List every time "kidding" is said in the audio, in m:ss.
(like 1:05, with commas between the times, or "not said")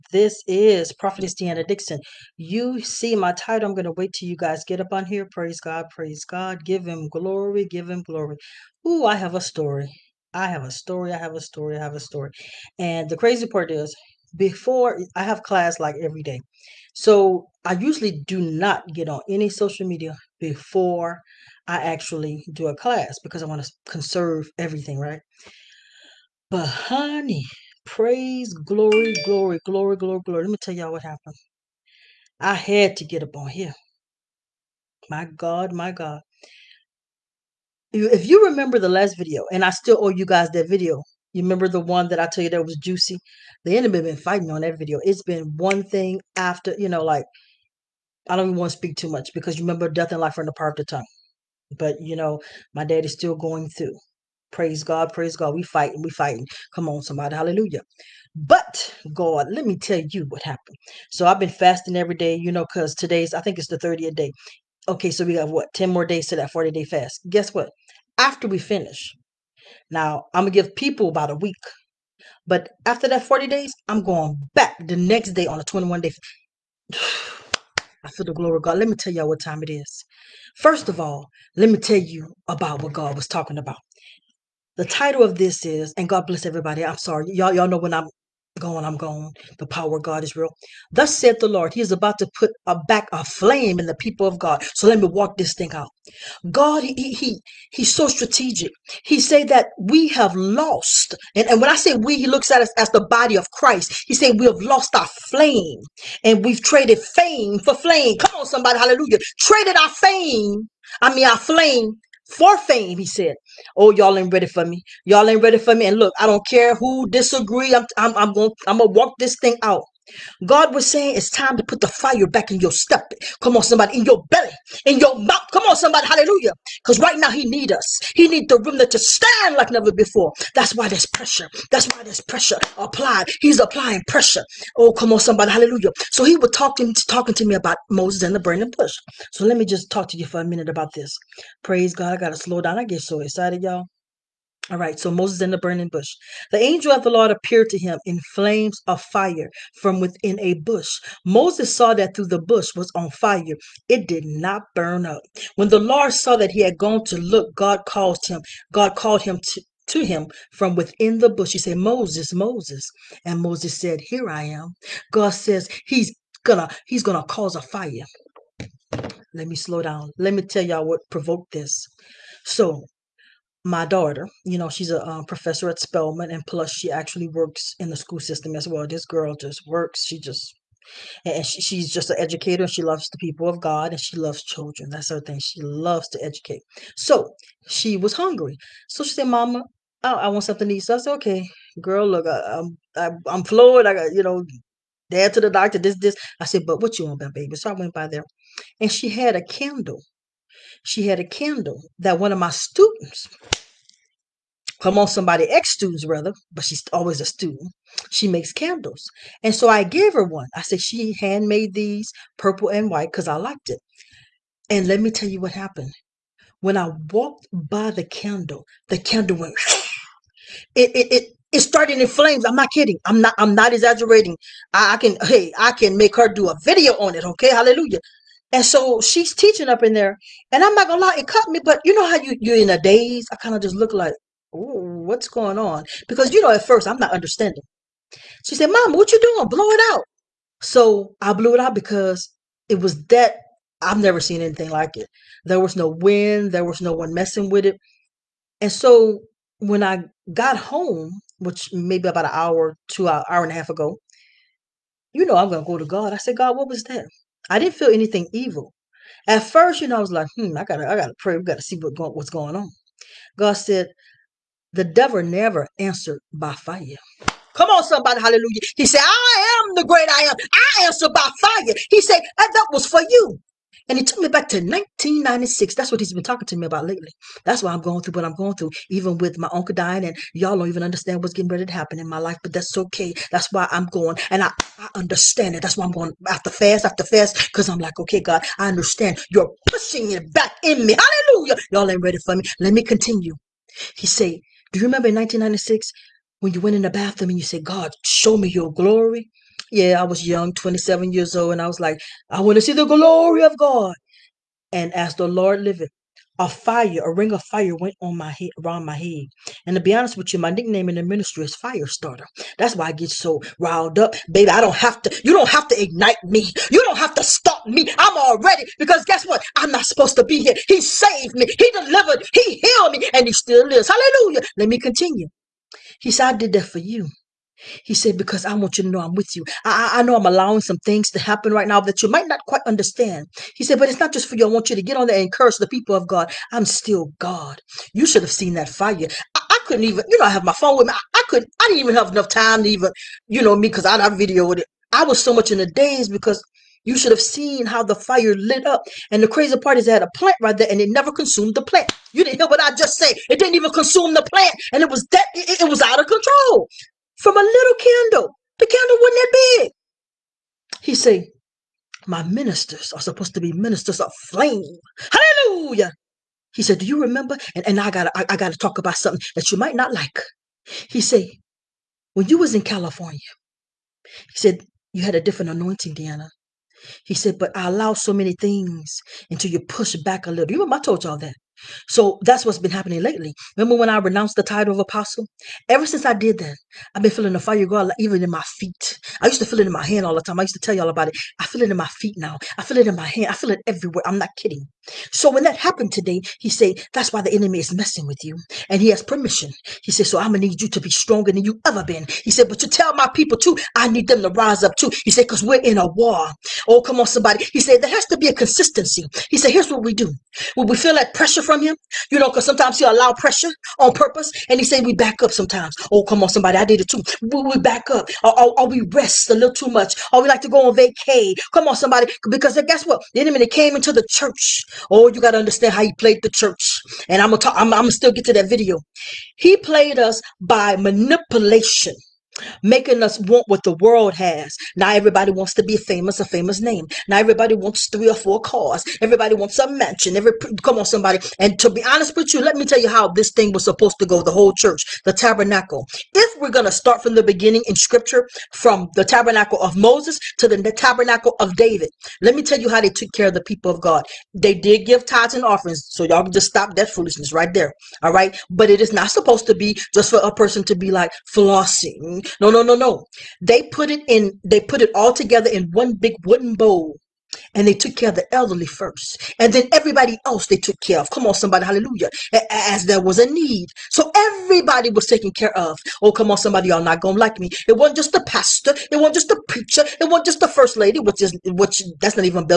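3:42, 6:34.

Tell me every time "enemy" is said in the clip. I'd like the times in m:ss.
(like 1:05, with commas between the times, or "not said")
0:43, 6:37, 7:03.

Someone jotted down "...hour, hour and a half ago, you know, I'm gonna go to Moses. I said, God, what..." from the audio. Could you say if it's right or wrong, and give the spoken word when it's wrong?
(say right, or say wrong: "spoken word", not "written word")
wrong: "God", not "Moses".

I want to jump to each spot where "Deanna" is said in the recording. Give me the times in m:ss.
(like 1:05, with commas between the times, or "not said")
0:01, 6:15.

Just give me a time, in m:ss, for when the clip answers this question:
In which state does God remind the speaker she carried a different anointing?
6:12.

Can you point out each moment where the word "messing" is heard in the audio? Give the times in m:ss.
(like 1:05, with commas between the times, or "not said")
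4:07, 6:37.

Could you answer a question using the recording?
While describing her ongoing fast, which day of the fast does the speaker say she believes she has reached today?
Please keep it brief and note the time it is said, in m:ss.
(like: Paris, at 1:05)
30th day, at 1:03.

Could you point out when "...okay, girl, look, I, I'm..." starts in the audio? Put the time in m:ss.
3:11.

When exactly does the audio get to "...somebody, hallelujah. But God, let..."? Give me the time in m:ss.
0:57.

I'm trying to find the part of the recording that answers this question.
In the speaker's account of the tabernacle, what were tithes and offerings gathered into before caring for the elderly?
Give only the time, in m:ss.
7:45.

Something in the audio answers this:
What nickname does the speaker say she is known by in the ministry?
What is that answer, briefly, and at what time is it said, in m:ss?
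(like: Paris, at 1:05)
Firestarter, at 5:11.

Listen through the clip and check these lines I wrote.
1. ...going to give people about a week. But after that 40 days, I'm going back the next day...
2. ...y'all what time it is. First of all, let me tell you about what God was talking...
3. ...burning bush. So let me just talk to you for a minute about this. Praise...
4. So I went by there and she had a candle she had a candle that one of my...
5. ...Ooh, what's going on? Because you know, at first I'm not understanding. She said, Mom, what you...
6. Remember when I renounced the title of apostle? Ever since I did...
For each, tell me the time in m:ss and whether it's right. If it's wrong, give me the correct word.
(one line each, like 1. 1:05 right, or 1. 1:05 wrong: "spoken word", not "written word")
1. 1:10 right
2. 1:19 right
3. 2:18 right
4. 3:17 right
5. 3:54 right
6. 6:23 right.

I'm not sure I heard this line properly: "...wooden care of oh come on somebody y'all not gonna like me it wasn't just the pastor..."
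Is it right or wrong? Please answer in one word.
wrong.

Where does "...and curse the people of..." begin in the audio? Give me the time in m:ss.
5:35.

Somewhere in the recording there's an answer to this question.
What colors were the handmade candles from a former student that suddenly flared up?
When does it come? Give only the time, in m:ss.
3:32.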